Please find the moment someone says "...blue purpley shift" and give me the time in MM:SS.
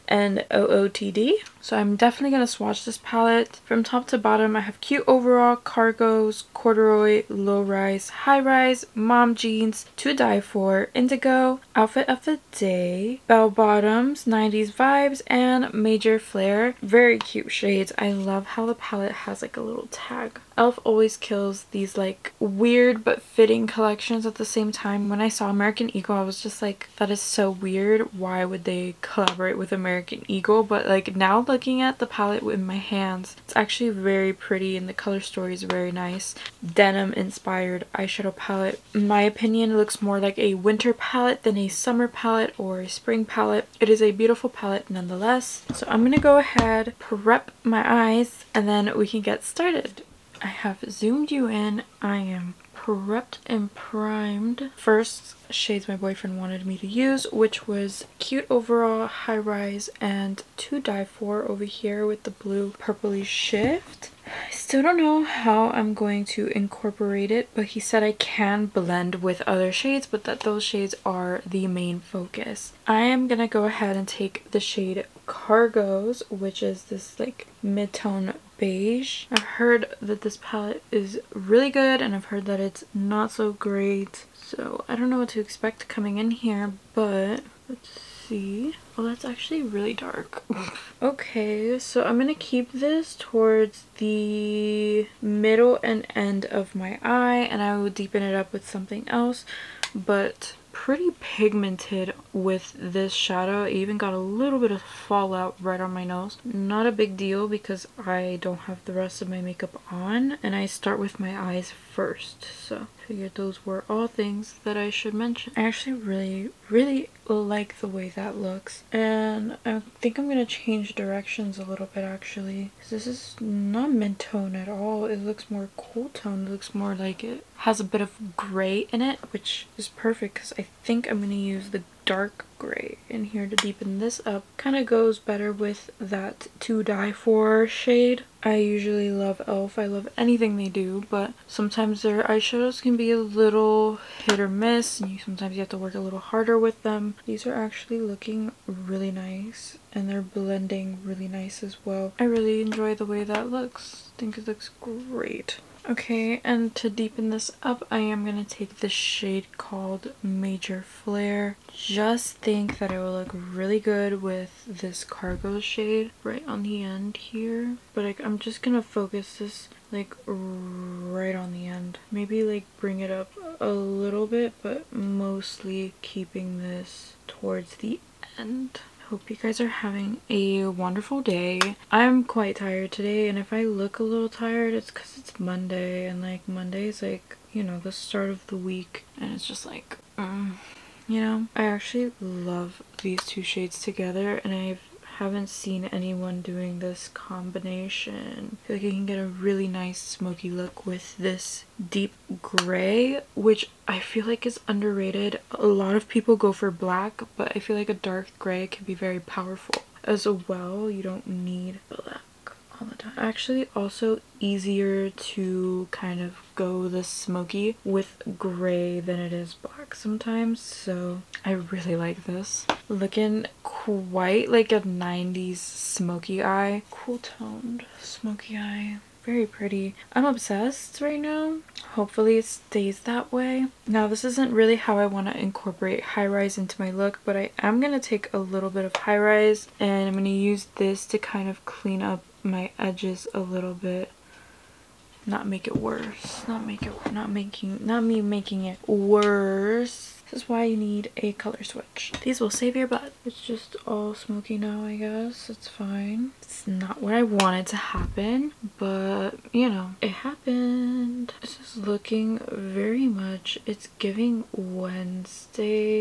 01:02.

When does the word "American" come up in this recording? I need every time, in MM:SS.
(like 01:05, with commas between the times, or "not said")
00:25, 00:29.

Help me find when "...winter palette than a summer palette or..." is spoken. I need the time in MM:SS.
00:40.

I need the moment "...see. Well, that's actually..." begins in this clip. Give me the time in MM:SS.
01:28.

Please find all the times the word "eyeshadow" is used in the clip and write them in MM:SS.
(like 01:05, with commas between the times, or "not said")
00:37, 02:22.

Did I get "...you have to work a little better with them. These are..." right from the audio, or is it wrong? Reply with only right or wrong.
wrong.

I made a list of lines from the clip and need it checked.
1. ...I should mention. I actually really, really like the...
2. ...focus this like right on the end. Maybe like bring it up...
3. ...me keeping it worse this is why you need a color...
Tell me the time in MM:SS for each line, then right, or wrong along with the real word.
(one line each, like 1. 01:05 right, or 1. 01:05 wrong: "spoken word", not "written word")
1. 01:54 right
2. 02:48 right
3. 04:08 wrong: "making", not "keeping".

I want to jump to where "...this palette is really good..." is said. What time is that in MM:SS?
01:20.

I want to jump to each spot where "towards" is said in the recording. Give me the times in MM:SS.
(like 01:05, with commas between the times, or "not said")
01:33, 02:57.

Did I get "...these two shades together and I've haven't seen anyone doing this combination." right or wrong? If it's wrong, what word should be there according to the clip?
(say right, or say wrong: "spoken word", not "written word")
right.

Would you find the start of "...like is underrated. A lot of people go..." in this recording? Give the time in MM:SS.
03:24.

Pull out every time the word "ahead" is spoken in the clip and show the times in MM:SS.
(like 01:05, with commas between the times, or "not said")
00:46, 01:13.